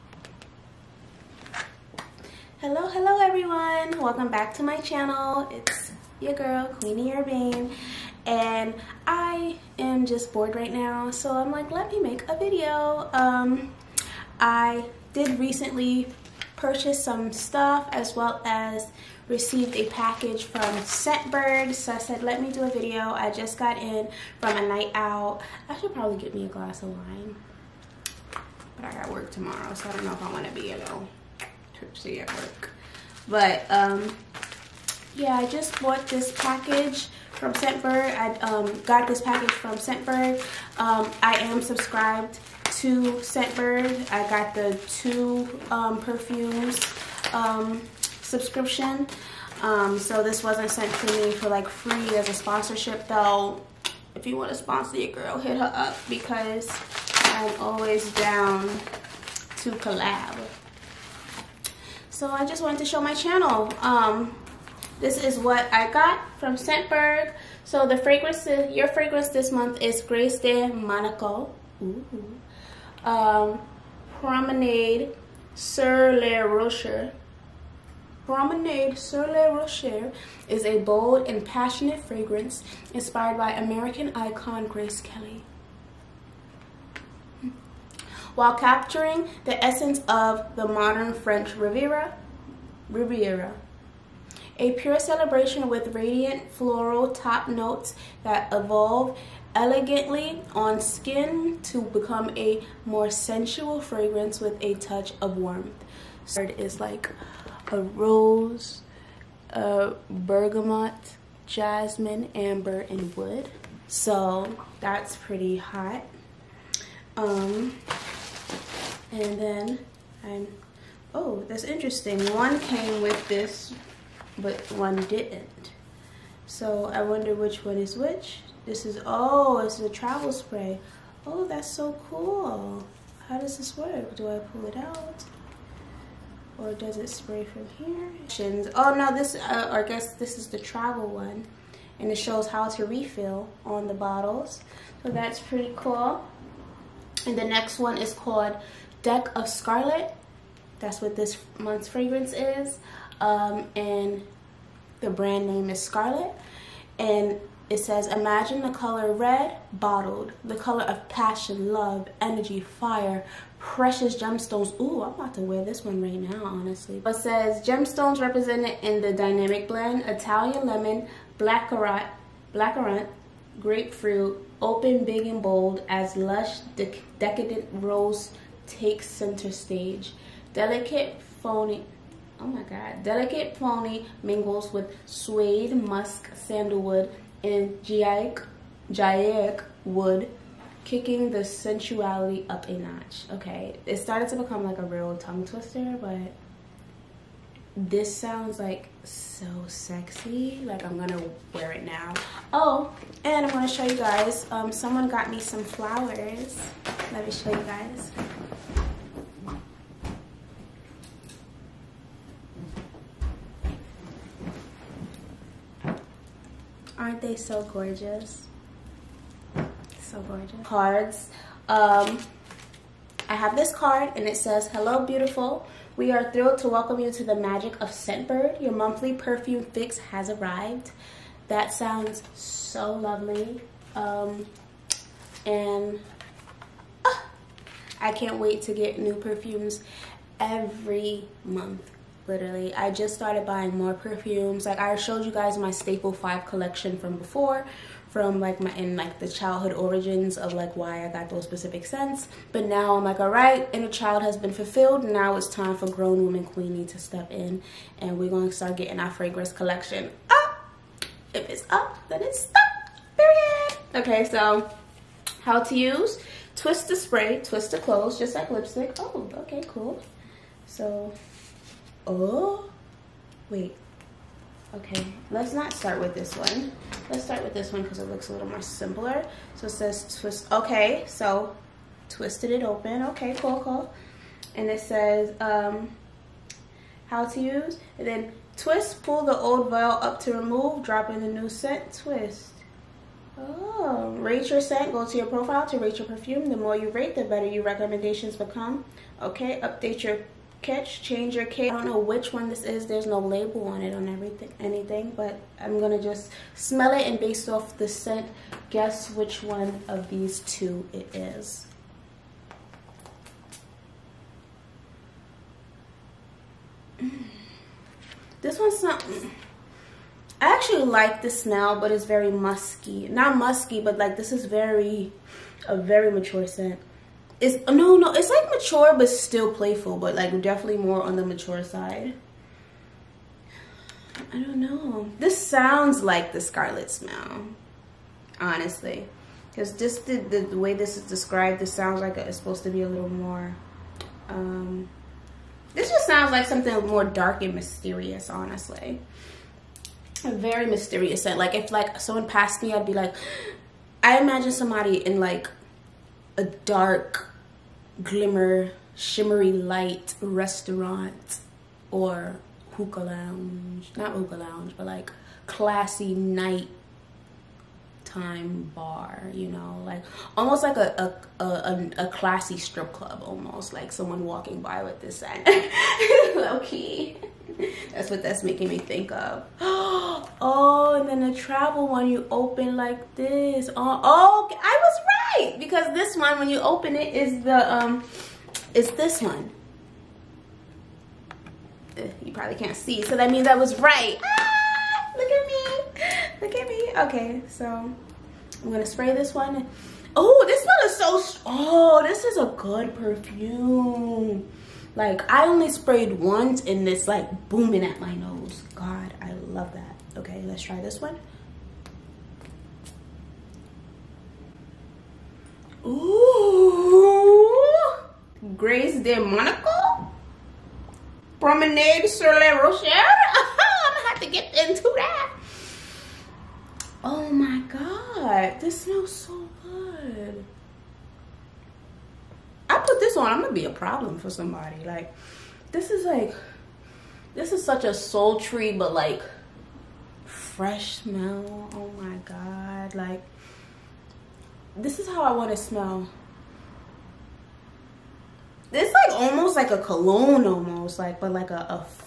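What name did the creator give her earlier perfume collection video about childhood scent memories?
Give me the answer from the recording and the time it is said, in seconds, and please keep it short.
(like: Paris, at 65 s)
Staple 5, at 245 s.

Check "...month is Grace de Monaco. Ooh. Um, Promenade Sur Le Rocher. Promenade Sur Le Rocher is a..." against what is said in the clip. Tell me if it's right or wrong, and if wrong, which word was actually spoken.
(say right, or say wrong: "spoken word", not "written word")
right.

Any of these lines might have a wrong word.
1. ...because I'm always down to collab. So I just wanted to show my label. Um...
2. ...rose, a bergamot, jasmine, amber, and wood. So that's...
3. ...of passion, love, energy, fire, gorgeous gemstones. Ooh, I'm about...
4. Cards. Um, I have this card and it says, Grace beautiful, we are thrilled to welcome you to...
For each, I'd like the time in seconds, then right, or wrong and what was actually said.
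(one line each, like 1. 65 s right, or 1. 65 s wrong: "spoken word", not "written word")
1. 56 s wrong: "channel", not "label"
2. 107 s right
3. 160 s wrong: "precious", not "gorgeous"
4. 220 s wrong: "Hello", not "Grace".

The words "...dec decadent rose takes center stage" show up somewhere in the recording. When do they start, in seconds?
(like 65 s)
176 s.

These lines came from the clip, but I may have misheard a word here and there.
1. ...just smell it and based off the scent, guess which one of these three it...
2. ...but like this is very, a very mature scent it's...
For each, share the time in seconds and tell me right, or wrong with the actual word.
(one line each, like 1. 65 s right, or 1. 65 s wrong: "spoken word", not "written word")
1. 306 s wrong: "two", not "three"
2. 323 s right.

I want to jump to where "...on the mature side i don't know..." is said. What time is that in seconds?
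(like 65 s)
331 s.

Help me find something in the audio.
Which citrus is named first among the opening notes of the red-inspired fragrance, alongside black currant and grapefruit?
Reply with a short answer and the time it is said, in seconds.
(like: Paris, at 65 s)
Italian lemon, at 170 s.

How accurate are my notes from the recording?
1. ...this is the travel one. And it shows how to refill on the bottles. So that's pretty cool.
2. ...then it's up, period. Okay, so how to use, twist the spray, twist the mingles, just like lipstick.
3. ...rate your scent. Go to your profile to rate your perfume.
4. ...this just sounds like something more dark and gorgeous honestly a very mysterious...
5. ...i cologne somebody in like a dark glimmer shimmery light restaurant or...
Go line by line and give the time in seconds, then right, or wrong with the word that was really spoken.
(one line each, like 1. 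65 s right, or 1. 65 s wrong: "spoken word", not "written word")
1. 140 s right
2. 262 s wrong: "clothes", not "mingles"
3. 294 s right
4. 345 s wrong: "mysterious", not "gorgeous"
5. 354 s wrong: "imagine", not "cologne".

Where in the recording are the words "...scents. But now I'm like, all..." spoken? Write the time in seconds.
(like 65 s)
251 s.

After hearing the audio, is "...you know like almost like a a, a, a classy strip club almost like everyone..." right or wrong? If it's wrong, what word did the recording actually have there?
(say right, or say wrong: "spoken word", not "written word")
wrong: "someone", not "everyone".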